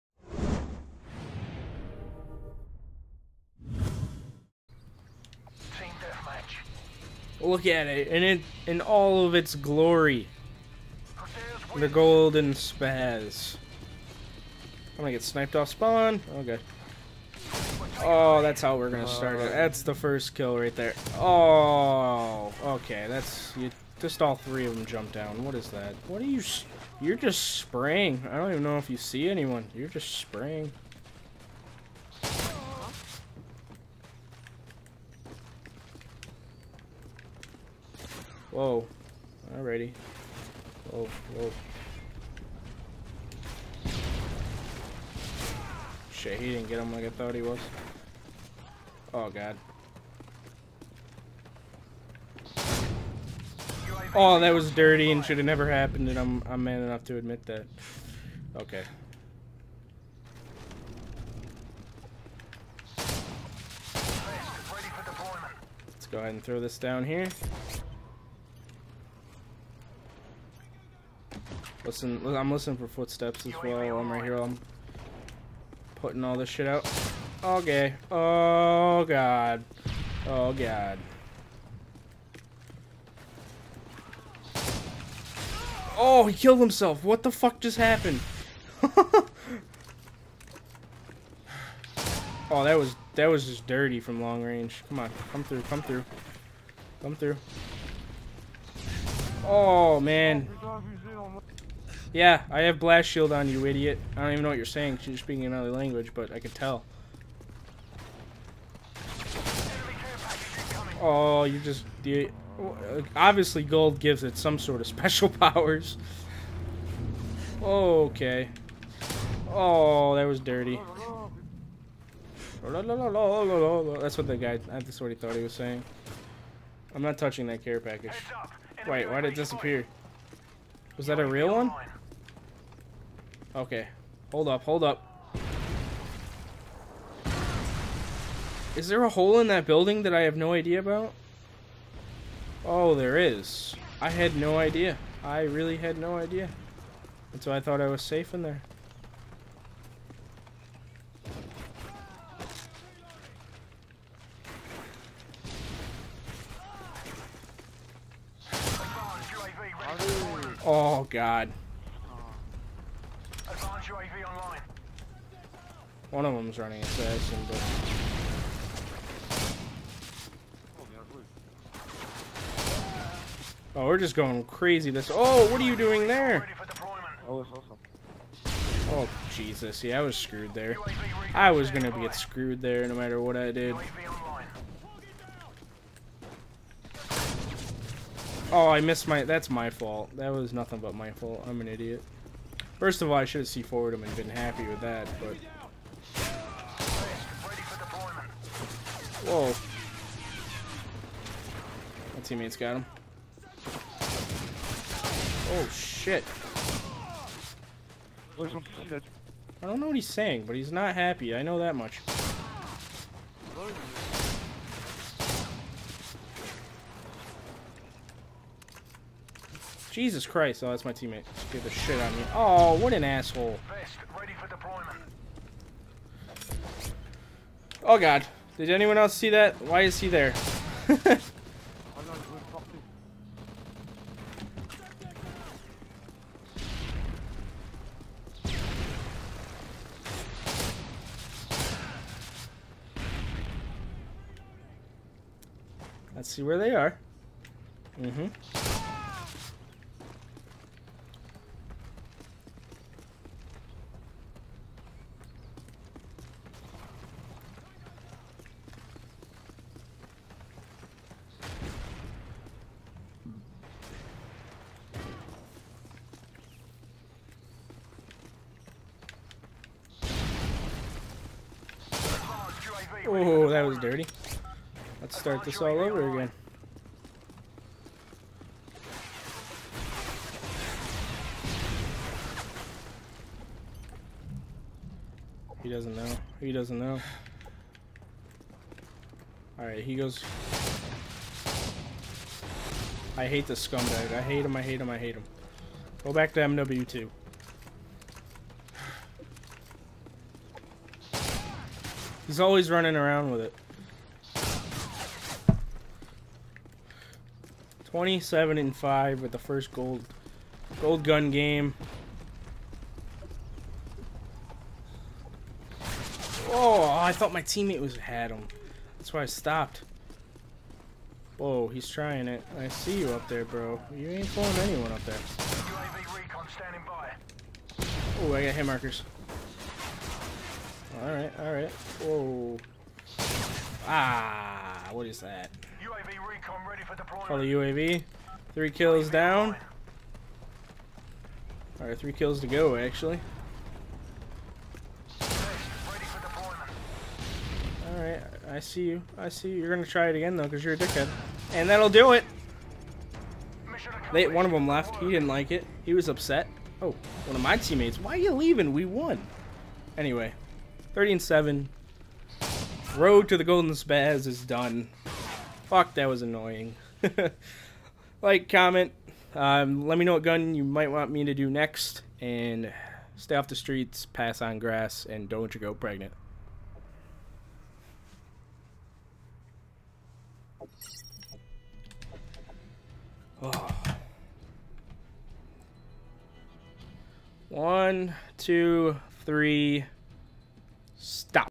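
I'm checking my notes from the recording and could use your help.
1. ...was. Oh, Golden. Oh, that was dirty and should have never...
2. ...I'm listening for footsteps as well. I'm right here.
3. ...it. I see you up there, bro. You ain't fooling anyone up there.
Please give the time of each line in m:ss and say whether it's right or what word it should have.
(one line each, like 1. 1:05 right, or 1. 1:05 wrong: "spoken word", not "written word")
1. 0:47 wrong: "God", not "Golden"
2. 1:12 right
3. 5:22 right.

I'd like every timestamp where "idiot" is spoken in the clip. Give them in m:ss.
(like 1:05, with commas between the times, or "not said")
1:43, 3:11.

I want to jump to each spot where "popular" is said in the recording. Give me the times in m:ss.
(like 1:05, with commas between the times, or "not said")
not said.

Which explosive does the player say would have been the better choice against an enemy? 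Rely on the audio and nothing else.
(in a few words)
C4.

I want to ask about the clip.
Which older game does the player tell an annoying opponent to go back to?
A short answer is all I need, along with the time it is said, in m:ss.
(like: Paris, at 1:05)
MW2, at 4:56.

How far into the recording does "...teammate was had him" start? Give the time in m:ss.
5:17.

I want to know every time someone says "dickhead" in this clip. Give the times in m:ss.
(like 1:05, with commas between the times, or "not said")
5:50.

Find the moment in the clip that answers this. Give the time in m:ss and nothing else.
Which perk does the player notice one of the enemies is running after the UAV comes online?
2:46.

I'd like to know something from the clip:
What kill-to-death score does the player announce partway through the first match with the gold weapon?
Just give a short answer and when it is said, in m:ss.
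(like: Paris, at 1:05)
27 and 5, at 5:07.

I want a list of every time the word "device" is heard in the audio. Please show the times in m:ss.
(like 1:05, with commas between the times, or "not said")
not said.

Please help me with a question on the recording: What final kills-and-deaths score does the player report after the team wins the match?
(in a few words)
30 and 7.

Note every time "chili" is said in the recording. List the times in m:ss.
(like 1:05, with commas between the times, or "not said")
not said.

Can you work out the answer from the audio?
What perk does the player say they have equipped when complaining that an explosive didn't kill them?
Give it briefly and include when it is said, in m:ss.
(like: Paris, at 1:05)
Blast shield, at 1:42.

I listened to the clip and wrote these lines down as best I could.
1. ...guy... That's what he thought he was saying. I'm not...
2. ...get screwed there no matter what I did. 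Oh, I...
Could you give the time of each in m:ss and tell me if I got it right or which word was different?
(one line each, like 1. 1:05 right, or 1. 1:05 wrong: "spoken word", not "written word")
1. 2:04 right
2. 3:01 right.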